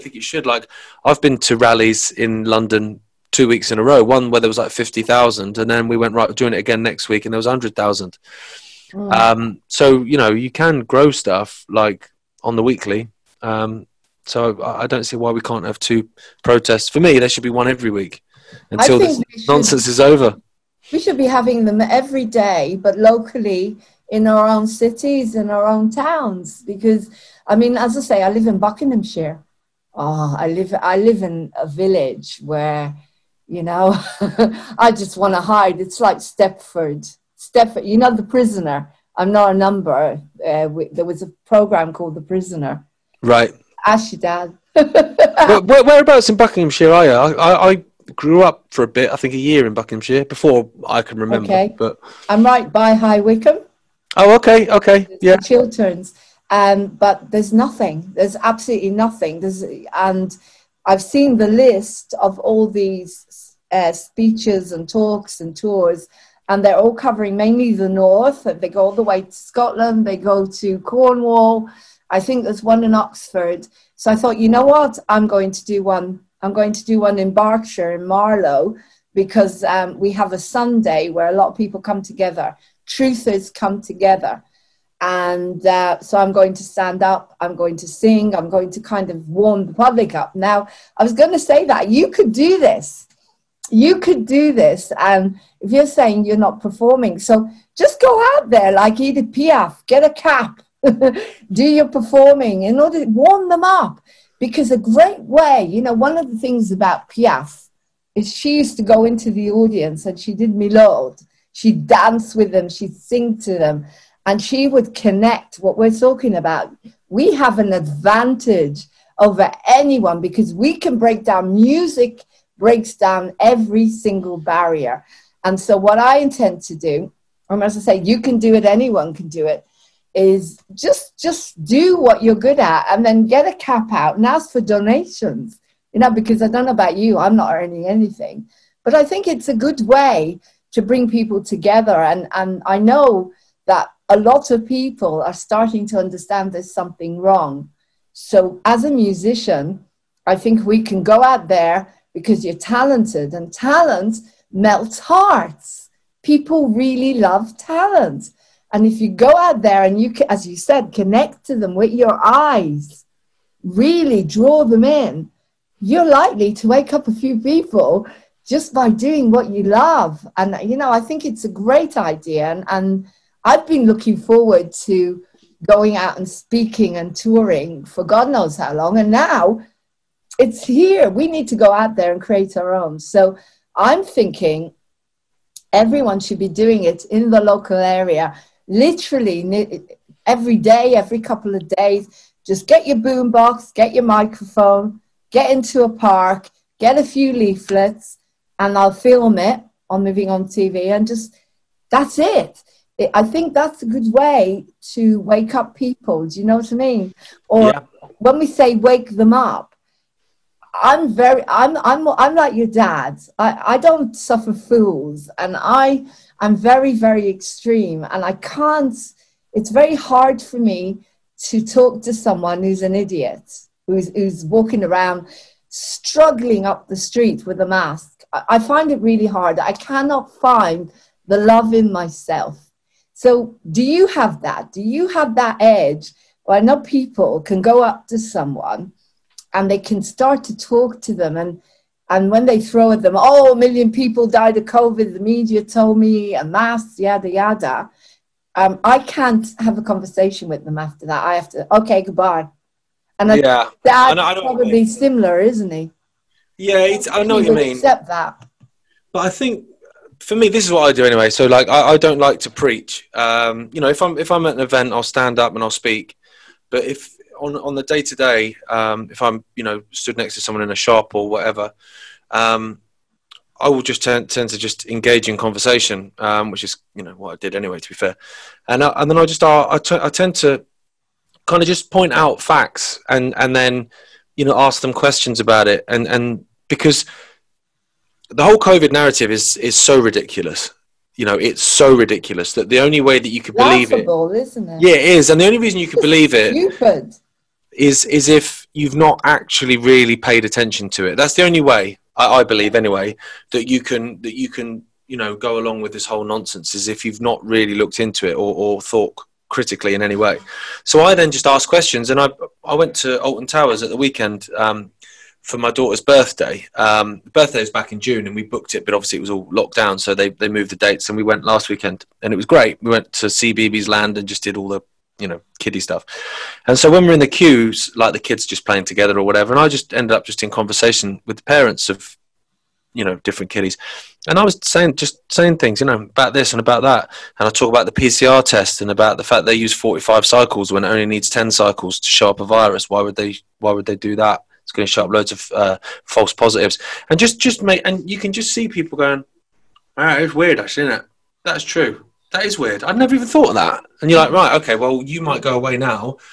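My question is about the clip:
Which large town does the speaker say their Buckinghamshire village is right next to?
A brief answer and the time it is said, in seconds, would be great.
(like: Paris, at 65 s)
High Wycombe, at 52 s.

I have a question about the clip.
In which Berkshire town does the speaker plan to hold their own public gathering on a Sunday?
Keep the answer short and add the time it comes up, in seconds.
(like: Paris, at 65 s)
Marlow, at 78 s.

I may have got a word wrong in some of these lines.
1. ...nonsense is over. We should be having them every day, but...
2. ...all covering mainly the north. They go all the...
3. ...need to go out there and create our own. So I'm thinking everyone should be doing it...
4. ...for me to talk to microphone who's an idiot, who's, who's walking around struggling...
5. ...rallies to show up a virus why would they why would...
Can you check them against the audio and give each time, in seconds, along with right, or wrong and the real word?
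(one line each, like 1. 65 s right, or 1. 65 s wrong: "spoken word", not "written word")
1. 19 s right
2. 66 s right
3. 181 s right
4. 220 s wrong: "someone", not "microphone"
5. 341 s wrong: "cycles", not "rallies".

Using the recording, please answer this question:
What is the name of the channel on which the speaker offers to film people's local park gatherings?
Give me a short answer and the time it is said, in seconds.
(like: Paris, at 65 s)
Moving On TV, at 200 s.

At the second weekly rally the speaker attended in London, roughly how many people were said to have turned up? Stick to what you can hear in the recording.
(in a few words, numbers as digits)
100,000.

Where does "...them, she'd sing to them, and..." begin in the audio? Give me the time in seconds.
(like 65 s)
112 s.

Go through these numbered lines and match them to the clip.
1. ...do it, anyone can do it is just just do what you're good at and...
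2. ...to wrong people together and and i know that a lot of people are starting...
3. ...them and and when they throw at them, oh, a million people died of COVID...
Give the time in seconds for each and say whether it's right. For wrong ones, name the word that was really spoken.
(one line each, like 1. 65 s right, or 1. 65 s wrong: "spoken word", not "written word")
1. 128 s right
2. 140 s wrong: "bring", not "wrong"
3. 241 s right.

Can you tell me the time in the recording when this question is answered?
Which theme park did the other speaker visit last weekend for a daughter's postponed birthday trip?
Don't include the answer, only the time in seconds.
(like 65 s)
313 s.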